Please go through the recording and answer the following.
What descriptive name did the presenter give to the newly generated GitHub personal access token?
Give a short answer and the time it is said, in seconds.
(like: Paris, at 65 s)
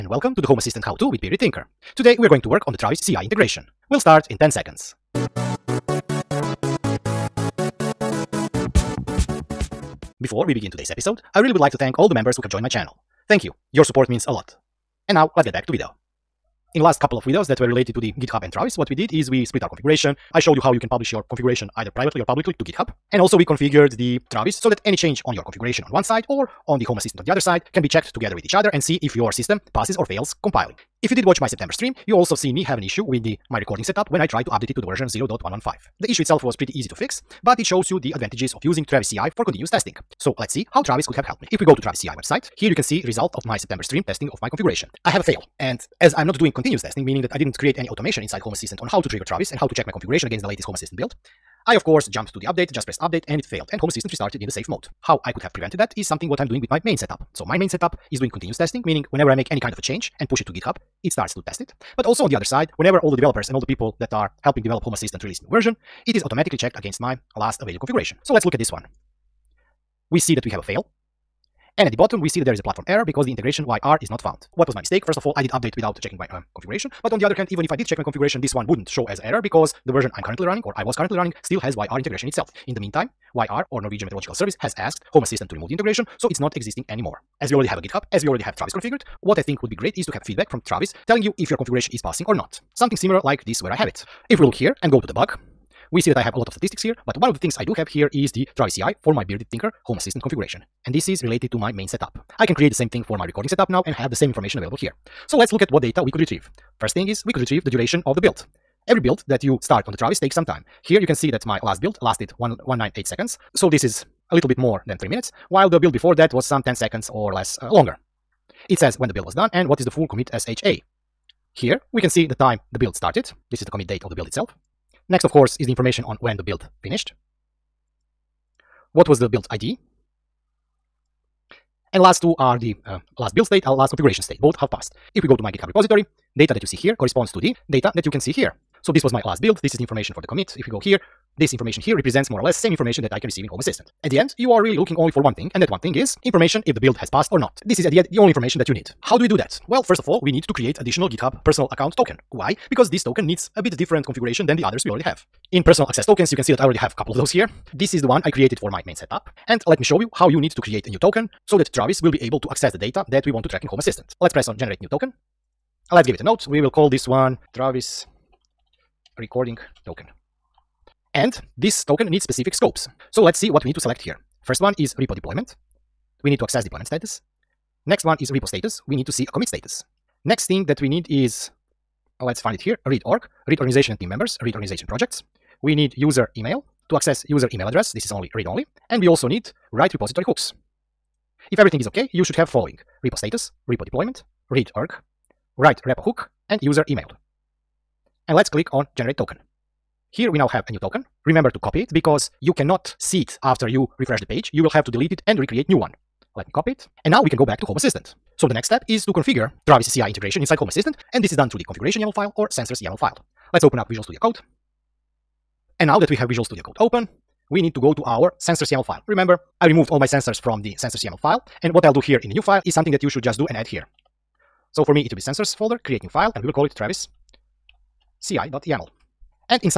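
Travis Recording Token, at 167 s.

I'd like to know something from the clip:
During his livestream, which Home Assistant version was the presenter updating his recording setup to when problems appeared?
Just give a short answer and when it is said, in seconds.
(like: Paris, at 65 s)
0.115, at 35 s.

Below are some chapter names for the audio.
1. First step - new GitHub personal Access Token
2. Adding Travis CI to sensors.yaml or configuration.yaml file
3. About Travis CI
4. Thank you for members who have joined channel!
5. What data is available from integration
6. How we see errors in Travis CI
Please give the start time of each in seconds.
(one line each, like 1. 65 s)
1. 149 s
2. 208 s
3. 16 s
4. 10 s
5. 105 s
6. 69 s.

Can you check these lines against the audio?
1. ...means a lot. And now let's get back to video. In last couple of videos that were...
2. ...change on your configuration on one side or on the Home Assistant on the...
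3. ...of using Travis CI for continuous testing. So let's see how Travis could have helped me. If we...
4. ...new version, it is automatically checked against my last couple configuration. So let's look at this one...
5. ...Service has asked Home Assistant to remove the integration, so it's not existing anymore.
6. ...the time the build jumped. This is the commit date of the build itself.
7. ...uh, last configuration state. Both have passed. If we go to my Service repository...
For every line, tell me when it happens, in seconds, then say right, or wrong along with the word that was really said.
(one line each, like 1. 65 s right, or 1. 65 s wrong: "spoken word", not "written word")
1. 14 s right
2. 24 s right
3. 38 s right
4. 65 s wrong: "available", not "couple"
5. 84 s right
6. 122 s wrong: "started", not "jumped"
7. 133 s wrong: "GitHub", not "Service".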